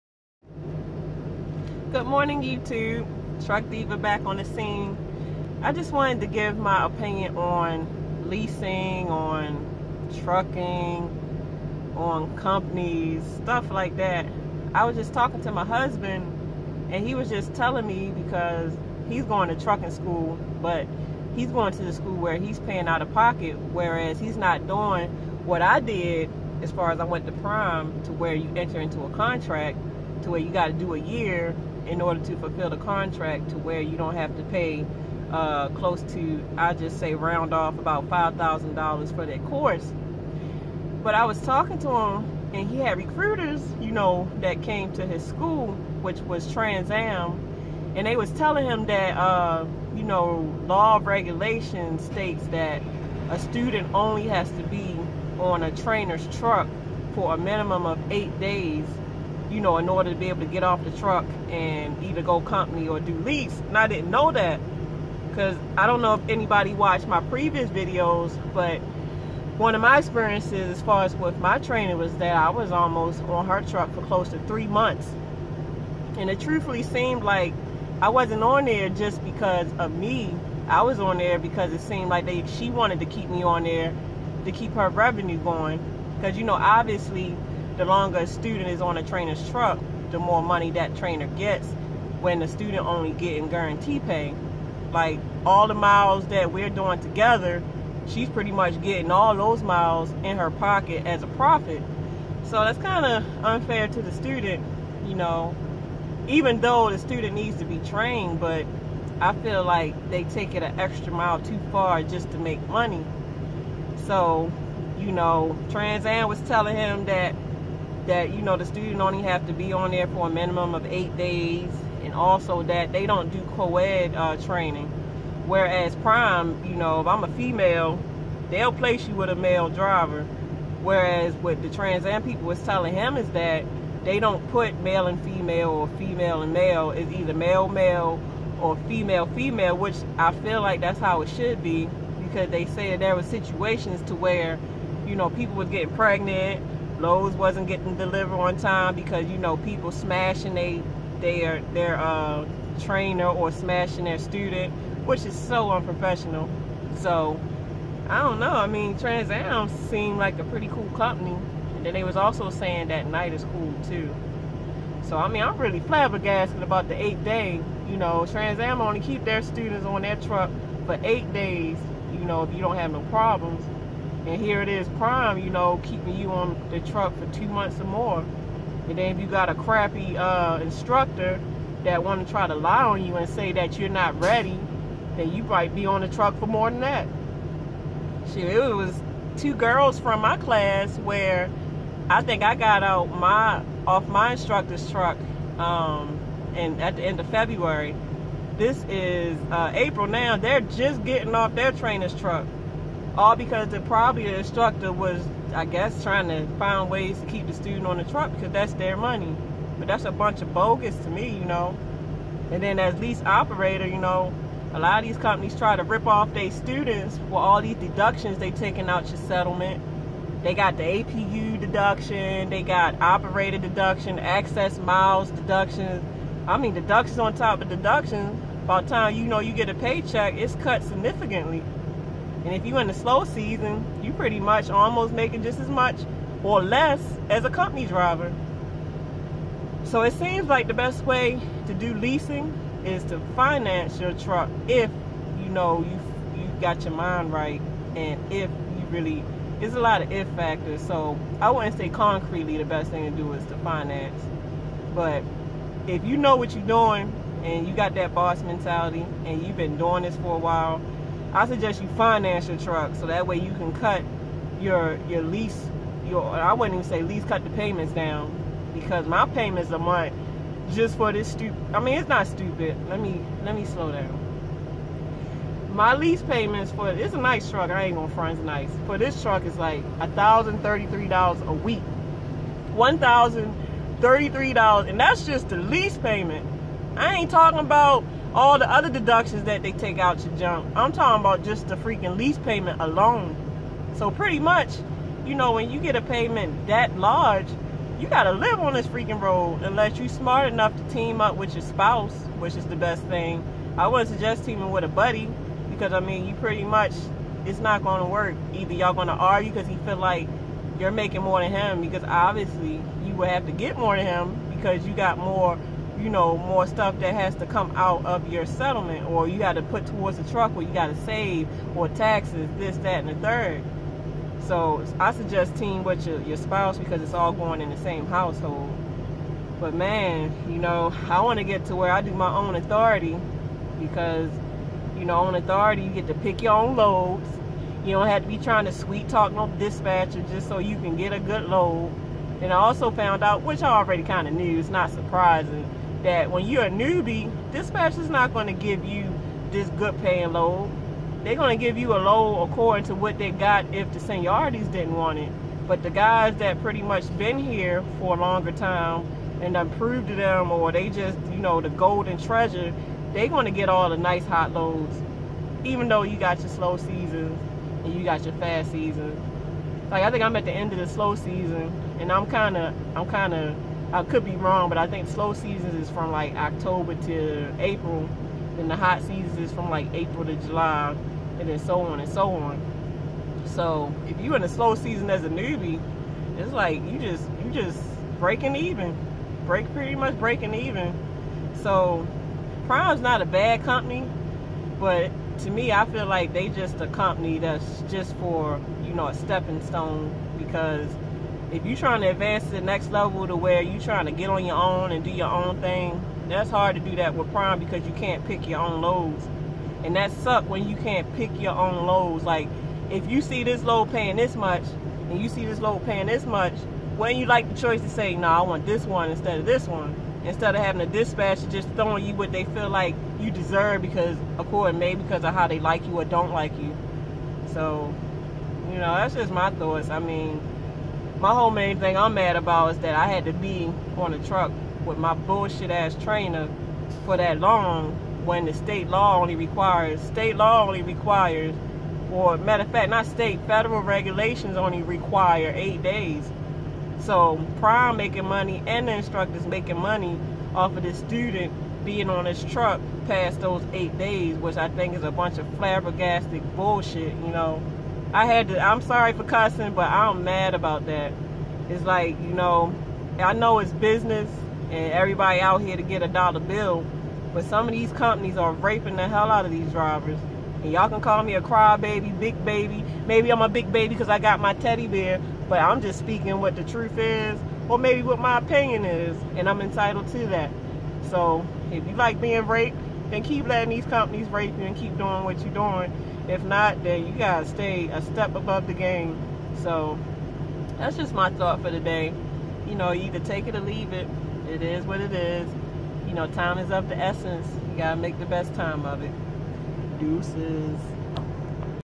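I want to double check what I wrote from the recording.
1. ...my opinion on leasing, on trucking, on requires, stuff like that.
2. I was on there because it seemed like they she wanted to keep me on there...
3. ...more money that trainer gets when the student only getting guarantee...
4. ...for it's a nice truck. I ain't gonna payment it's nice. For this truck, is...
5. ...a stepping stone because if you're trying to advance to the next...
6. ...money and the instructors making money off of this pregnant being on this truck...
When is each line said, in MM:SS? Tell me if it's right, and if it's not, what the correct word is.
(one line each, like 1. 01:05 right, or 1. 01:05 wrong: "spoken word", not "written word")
1. 00:06 wrong: "companies", not "requires"
2. 01:20 right
3. 01:30 right
4. 04:36 wrong: "front", not "payment"
5. 06:39 right
6. 07:28 wrong: "student", not "pregnant".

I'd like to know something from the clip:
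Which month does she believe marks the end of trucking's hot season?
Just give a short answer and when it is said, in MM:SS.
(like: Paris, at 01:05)
July, at 06:20.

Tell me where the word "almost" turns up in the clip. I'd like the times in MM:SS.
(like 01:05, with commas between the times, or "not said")
01:12, 03:54.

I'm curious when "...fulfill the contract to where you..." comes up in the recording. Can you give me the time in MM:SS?
00:32.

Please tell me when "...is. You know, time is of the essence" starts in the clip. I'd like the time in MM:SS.
08:15.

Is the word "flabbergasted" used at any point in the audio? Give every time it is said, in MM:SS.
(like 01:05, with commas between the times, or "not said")
02:45, 07:35.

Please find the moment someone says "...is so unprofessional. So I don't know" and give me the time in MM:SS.
02:35.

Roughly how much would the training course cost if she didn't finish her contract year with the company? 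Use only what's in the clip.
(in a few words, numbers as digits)
$5,000.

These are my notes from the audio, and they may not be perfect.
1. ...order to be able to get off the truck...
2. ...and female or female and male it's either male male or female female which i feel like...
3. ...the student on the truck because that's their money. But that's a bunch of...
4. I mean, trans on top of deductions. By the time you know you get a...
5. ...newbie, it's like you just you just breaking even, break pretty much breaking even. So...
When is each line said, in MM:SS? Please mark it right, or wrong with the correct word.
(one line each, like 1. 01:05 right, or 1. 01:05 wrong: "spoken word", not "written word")
1. 00:59 right
2. 02:15 right
3. 03:27 right
4. 03:46 wrong: "deductions", not "trans"
5. 06:25 right.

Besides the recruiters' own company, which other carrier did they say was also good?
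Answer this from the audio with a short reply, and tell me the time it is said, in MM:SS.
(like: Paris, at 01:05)
Knight, at 02:43.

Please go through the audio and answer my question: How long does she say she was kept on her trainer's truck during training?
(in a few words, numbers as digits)
close to three months.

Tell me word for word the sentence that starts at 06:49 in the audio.
And that suck when you can't pick your own loads.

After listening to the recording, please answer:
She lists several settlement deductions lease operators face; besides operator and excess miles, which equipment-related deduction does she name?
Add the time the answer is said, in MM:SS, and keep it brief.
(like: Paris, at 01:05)
APU deduction, at 03:40.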